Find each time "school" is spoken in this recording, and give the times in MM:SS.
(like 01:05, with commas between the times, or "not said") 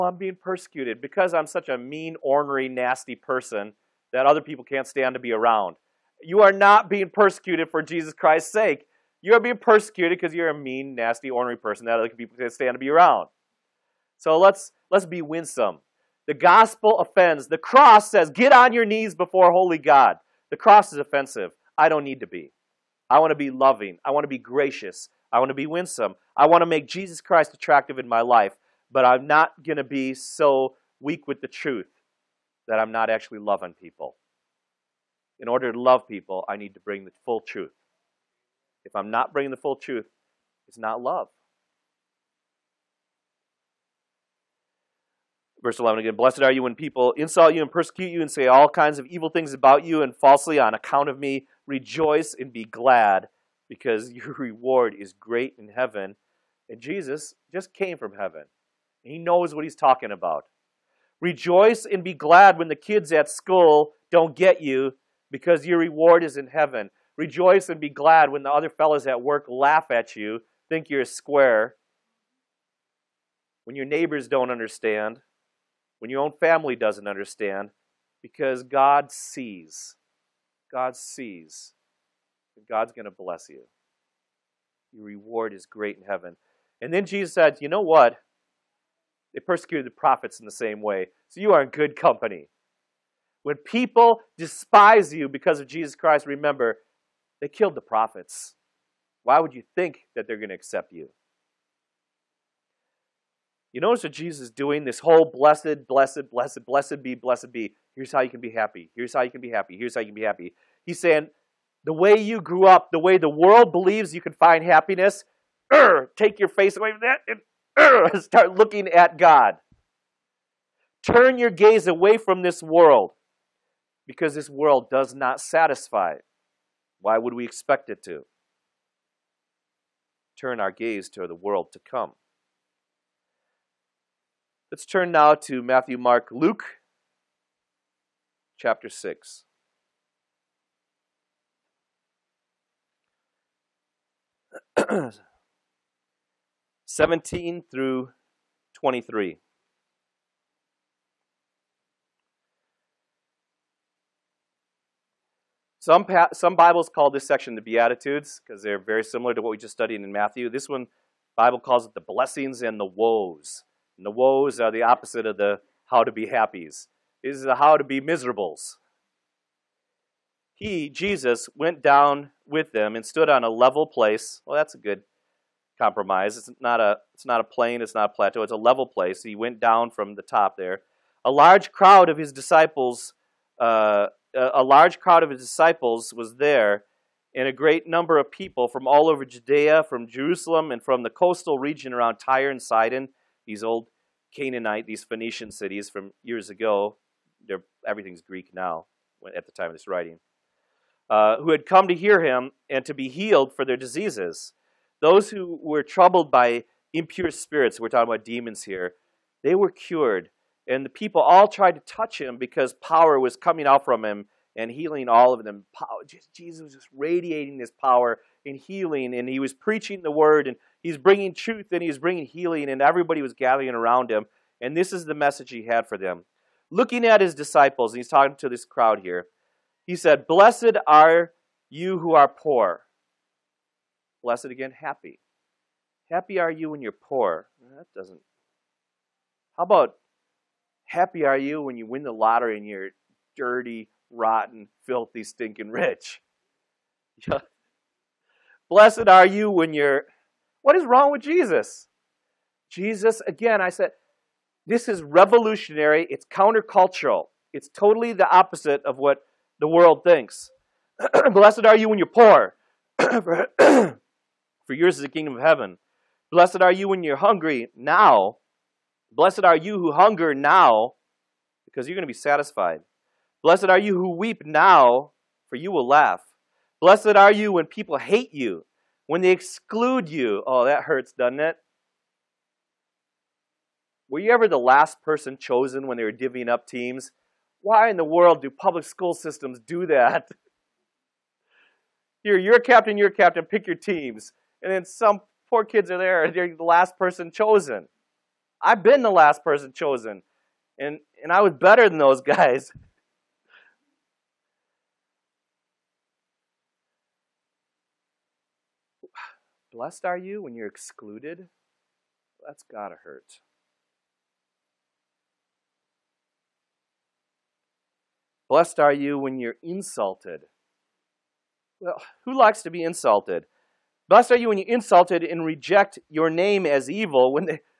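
01:03, 04:48.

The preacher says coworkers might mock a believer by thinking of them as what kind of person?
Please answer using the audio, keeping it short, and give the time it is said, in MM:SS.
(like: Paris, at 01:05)
A square, at 01:11.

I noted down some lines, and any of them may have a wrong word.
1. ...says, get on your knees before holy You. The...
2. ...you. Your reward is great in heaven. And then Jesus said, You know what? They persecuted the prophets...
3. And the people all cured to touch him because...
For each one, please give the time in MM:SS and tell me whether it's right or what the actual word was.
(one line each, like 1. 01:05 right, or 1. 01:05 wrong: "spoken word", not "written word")
1. 00:18 wrong: "God", not "You"
2. 01:23 right
3. 03:30 wrong: "tried", not "cured".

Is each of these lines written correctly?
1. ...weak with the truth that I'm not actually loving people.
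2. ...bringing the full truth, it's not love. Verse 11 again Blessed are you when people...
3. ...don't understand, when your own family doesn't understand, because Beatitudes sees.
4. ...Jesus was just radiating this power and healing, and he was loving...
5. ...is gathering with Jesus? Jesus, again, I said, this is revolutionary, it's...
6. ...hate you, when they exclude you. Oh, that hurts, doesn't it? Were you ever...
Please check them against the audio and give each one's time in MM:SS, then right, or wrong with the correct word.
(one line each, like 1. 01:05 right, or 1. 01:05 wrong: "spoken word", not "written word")
1. 00:31 right
2. 00:39 right
3. 01:14 wrong: "God", not "Beatitudes"
4. 03:36 wrong: "preaching", not "loving"
5. 04:10 wrong: "wrong", not "gathering"
6. 04:37 right.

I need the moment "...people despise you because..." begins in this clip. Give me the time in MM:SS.
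01:33.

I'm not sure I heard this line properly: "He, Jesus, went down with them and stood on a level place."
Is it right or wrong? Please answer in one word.
right.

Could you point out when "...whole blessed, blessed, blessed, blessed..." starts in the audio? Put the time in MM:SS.
01:45.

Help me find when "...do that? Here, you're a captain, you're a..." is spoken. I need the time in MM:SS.
04:49.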